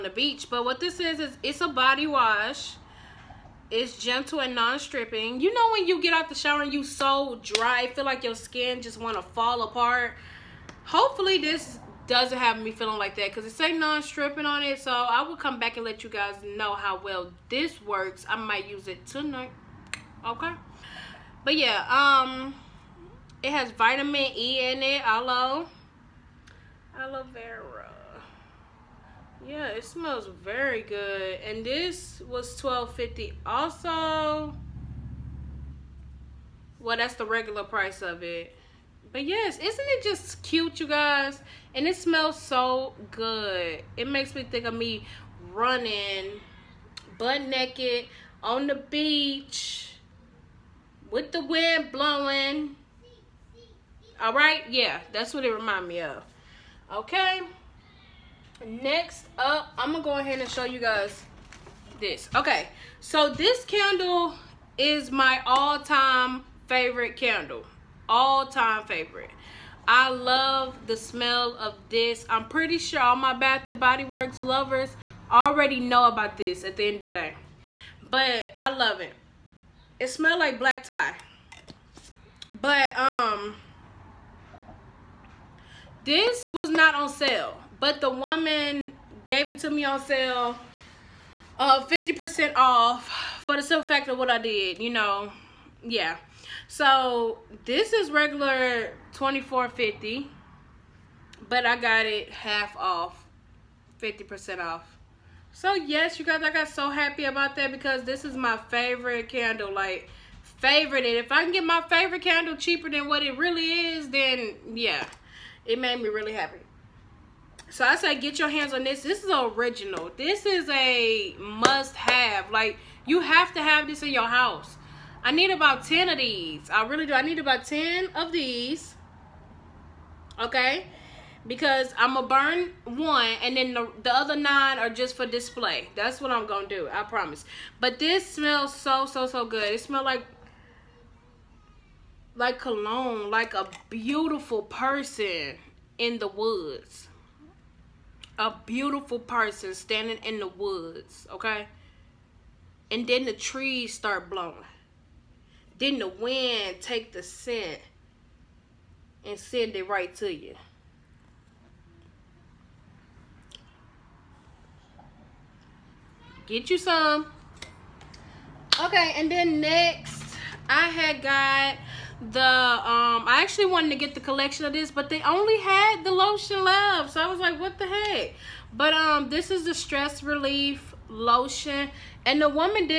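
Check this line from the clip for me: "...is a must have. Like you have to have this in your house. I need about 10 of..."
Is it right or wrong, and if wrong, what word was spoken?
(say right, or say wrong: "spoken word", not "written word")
right.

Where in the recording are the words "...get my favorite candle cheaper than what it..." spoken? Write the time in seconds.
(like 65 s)
111 s.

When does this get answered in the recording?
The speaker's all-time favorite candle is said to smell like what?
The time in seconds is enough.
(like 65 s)
80 s.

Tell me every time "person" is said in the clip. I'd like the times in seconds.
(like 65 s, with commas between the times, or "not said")
144 s, 149 s.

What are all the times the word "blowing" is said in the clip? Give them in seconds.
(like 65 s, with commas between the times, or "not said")
51 s, 154 s.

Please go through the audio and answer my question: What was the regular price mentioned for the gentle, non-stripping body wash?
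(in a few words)
$12.50.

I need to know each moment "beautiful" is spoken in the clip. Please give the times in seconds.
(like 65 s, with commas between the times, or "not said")
143 s, 148 s.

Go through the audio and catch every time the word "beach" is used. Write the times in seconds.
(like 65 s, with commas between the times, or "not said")
0 s, 48 s.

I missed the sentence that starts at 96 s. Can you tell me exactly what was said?
So this is regular 24.50, but I got it half off, 50% off.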